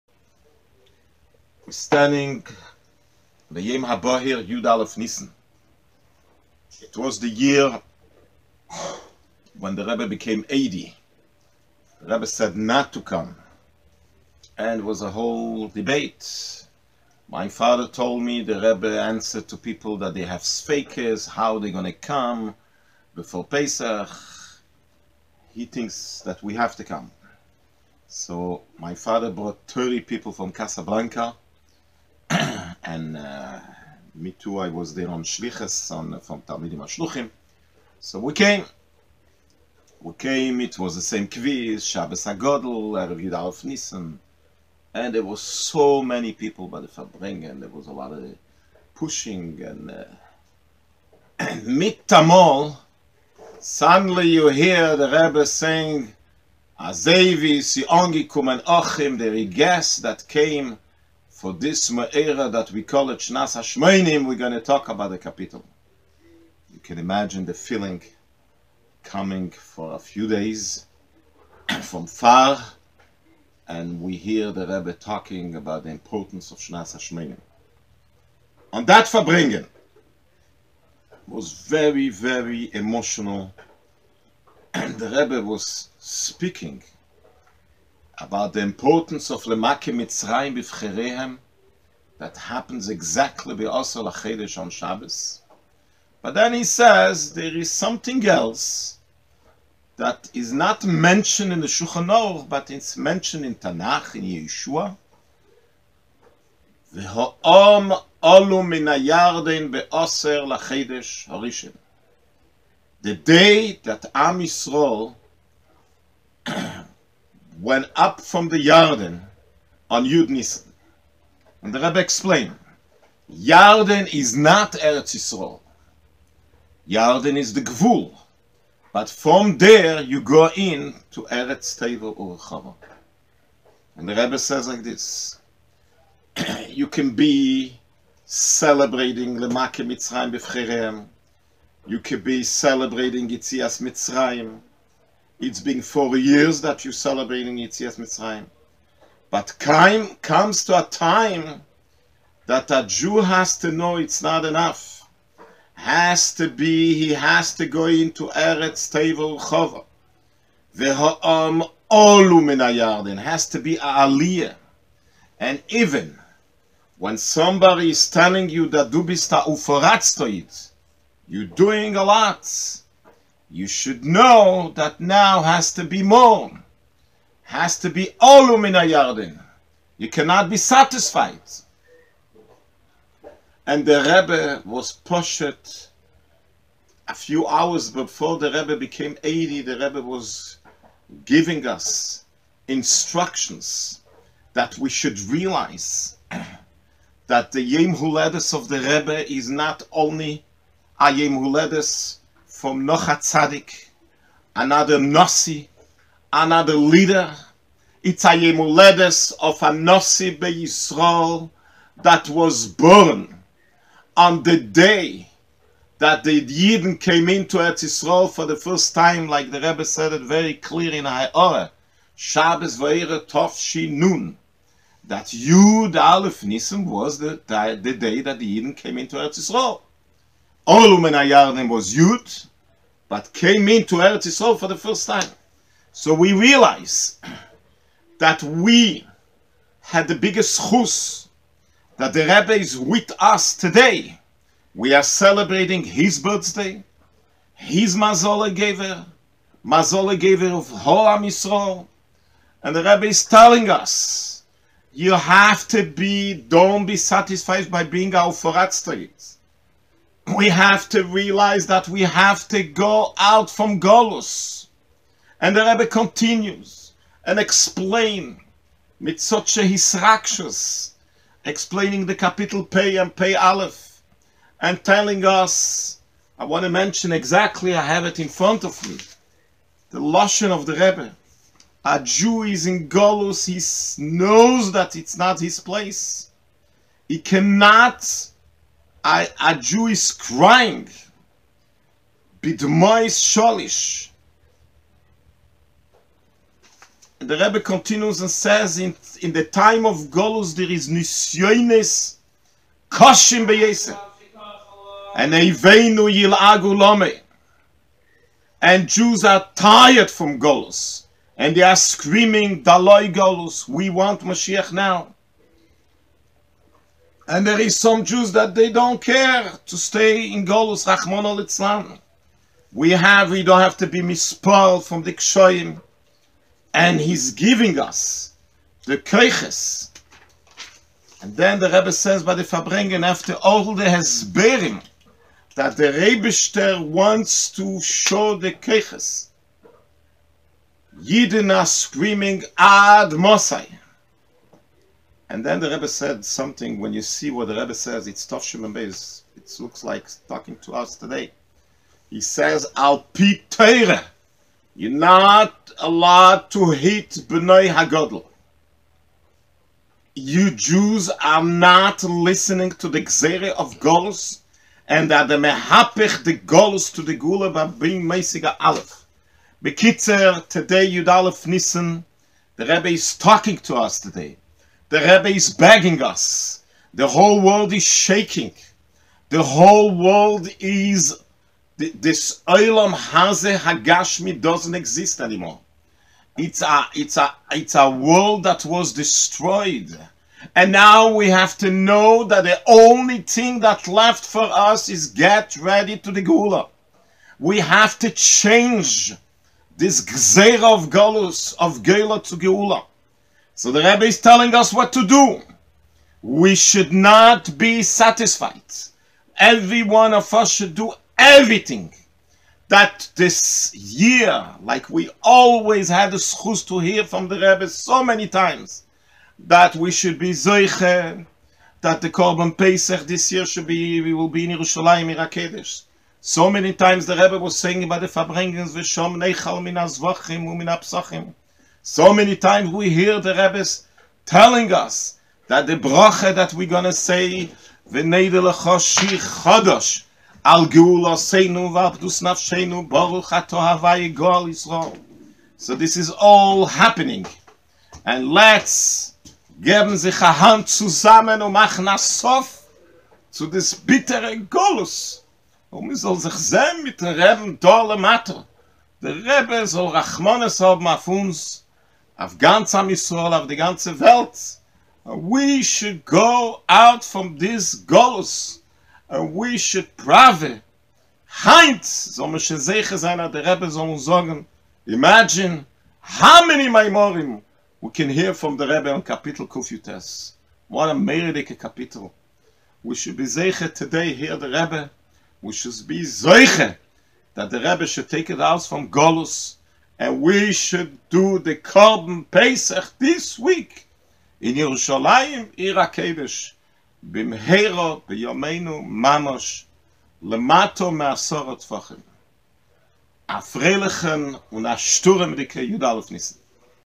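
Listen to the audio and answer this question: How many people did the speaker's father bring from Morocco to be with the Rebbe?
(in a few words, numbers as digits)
30.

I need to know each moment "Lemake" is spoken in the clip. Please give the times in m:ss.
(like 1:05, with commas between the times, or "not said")
1:29, 2:19.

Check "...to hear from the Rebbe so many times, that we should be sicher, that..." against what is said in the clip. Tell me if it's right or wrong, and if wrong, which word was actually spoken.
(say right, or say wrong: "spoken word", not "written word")
wrong: "zeicher", not "sicher".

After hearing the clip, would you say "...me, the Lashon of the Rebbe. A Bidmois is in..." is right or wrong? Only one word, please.
wrong.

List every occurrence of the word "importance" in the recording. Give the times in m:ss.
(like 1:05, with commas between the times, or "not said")
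1:15, 1:28.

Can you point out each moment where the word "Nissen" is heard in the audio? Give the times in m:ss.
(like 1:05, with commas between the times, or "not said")
0:43, 6:11.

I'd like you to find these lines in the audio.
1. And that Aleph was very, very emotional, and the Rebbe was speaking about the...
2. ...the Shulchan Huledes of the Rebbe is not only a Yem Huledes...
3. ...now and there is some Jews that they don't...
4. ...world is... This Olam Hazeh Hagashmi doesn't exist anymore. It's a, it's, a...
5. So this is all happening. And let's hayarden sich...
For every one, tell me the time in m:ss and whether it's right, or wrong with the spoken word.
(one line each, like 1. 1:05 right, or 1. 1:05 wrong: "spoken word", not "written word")
1. 1:18 wrong: "Verbringen", not "Aleph"
2. 3:17 wrong: "Yem", not "Shulchan"
3. 5:14 right
4. 6:19 right
5. 7:25 wrong: "geben", not "hayarden".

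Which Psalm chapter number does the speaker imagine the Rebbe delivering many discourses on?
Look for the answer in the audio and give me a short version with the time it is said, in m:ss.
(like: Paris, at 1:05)
Kufutes (119), at 7:59.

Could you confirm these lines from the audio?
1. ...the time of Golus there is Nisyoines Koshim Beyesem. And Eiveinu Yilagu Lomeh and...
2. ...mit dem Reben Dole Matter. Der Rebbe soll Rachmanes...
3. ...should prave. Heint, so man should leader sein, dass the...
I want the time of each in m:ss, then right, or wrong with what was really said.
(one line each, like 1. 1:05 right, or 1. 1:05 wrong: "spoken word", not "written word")
1. 4:59 right
2. 7:36 right
3. 7:49 wrong: "sicher", not "leader".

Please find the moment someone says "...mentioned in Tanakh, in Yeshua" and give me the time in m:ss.
1:42.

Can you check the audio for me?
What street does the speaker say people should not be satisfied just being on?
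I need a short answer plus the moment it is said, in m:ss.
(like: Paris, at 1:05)
Our Forat Street, at 4:18.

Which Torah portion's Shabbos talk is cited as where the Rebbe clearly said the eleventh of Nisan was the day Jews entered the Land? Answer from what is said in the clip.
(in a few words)
Vayera.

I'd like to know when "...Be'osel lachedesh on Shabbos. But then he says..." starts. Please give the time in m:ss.
1:33.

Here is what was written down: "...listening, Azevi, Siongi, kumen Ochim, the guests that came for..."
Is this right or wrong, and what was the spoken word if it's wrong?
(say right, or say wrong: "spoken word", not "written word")
wrong: "saying", not "listening".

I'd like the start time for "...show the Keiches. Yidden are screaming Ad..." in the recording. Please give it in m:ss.
5:37.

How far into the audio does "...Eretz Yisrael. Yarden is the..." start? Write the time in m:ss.
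2:04.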